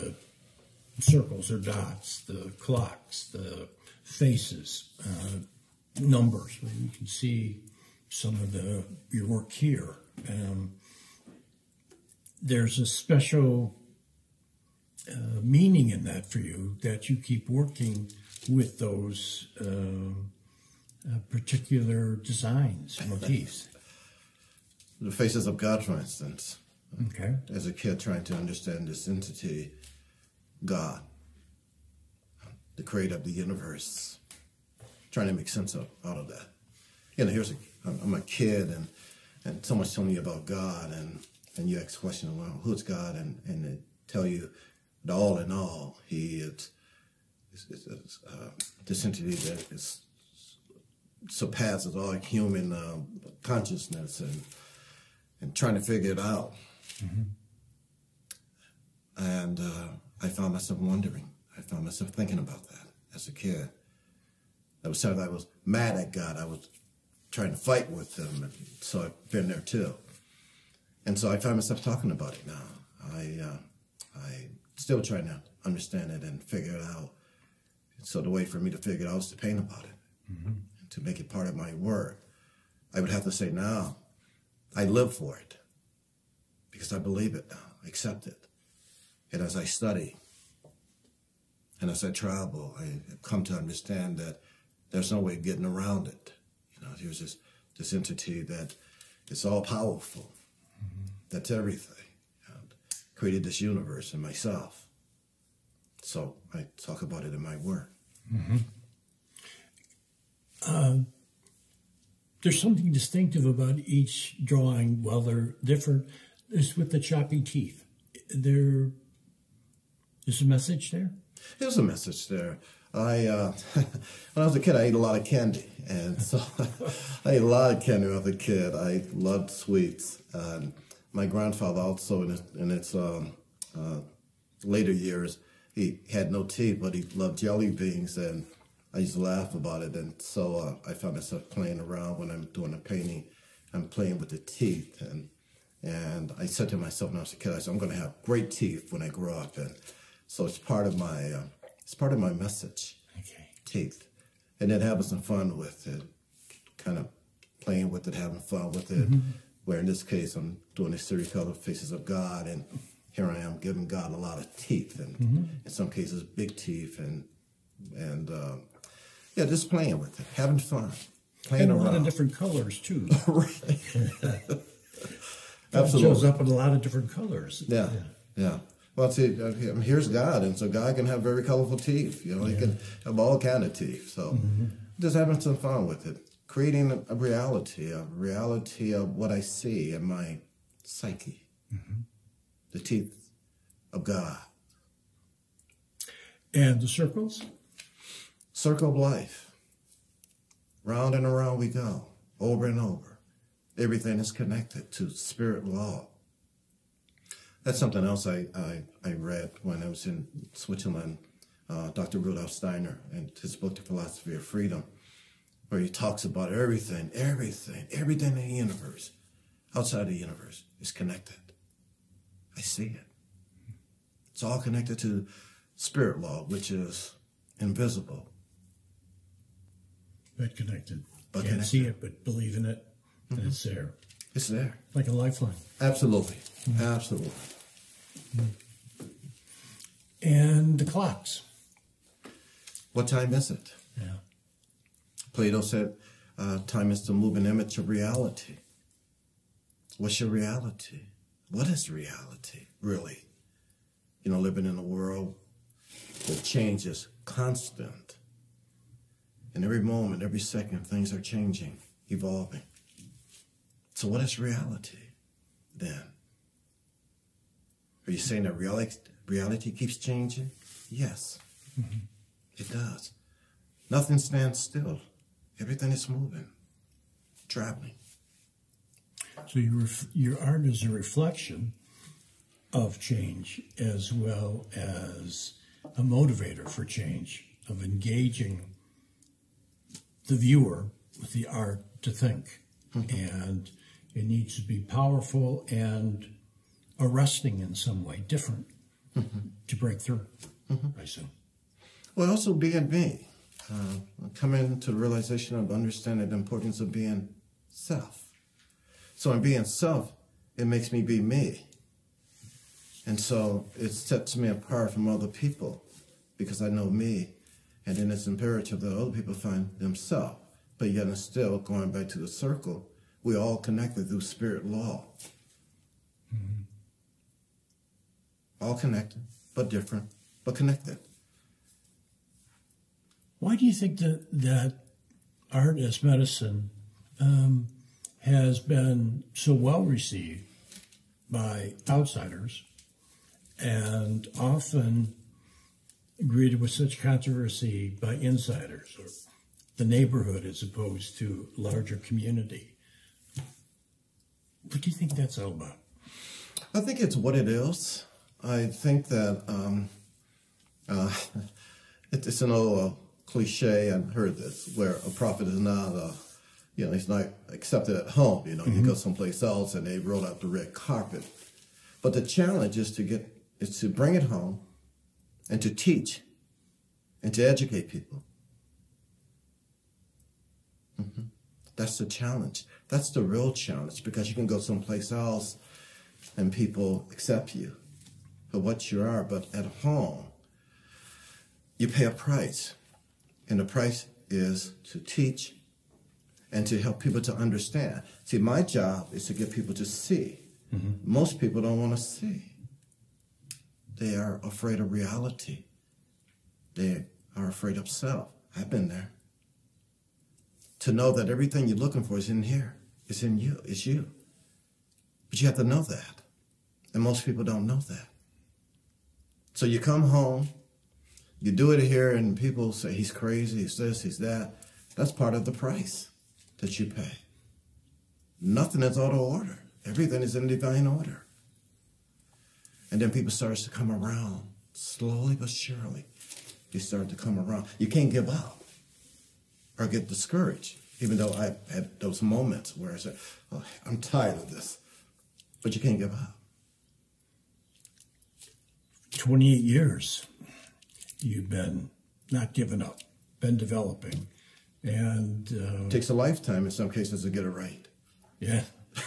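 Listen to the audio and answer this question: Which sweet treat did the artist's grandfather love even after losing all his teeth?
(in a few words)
jelly beans.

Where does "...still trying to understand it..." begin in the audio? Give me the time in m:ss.
1:14.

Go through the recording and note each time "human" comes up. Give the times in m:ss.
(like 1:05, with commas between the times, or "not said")
0:52.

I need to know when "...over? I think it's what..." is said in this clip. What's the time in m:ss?
5:55.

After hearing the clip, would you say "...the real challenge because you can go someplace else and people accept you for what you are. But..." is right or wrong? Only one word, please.
right.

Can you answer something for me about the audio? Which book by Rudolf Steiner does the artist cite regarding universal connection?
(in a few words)
The Philosophy of Freedom.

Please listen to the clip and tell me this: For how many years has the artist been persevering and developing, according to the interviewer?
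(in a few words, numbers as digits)
28.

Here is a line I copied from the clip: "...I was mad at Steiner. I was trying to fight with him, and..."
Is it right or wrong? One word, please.
wrong.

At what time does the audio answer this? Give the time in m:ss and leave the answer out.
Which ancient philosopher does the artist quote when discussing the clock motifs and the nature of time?
4:05.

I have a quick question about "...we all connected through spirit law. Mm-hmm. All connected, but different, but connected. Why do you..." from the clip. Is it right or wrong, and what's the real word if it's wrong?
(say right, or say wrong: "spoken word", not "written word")
right.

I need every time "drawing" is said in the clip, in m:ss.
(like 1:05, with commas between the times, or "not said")
1:54.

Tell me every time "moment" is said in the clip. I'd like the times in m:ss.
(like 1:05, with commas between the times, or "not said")
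4:19, 7:22.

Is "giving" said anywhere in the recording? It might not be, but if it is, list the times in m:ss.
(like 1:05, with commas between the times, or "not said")
2:43, 7:32.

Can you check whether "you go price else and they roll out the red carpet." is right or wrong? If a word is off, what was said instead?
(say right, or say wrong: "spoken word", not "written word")
wrong: "someplace", not "price".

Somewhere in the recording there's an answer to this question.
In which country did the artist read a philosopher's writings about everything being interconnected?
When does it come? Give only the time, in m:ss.
3:30.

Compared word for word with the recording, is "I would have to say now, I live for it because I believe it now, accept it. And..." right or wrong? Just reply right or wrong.
right.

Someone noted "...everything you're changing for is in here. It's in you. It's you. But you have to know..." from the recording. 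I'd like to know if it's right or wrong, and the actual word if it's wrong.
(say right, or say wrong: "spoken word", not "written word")
wrong: "looking", not "changing".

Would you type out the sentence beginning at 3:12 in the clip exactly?
the teeth of God, and the circles, circle of life.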